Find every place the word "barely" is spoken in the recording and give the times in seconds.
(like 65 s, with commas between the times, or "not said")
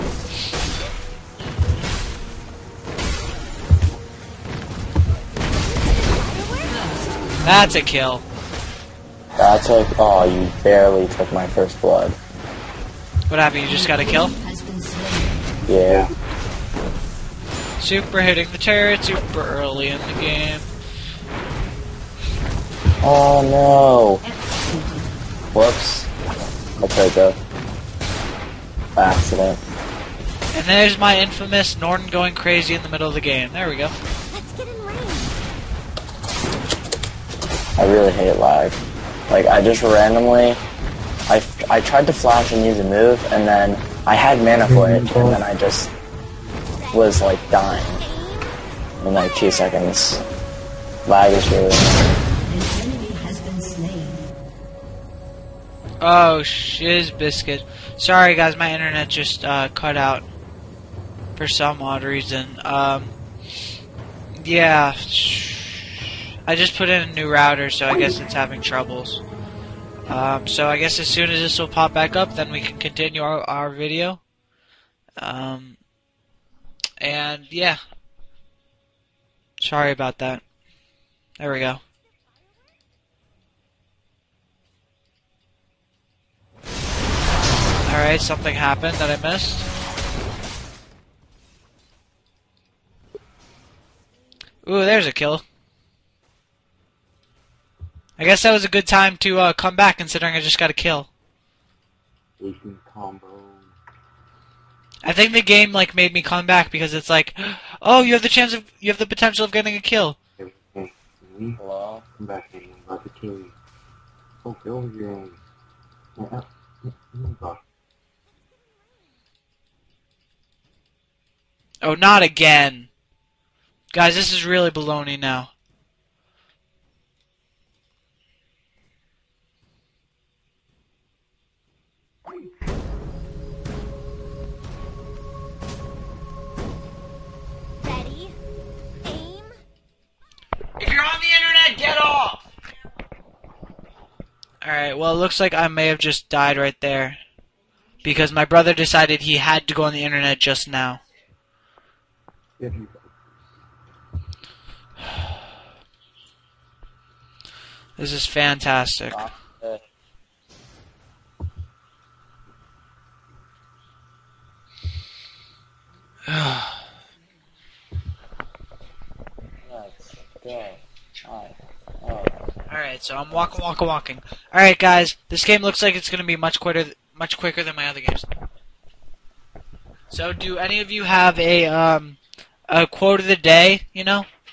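10 s.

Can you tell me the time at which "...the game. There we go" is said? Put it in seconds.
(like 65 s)
33 s.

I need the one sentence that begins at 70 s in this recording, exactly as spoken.
Um, so I guess as soon as this will pop back up, then we can continue our, our video.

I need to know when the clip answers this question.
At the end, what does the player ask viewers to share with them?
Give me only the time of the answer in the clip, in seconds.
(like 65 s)
182 s.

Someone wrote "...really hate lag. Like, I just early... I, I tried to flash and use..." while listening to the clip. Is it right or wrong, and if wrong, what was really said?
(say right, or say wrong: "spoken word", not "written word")
wrong: "randomly", not "early".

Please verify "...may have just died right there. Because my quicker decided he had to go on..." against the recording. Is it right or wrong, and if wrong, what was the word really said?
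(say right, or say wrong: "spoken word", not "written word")
wrong: "brother", not "quicker".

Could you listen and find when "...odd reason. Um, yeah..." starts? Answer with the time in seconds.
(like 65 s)
61 s.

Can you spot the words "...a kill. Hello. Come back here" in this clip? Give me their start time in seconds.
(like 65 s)
109 s.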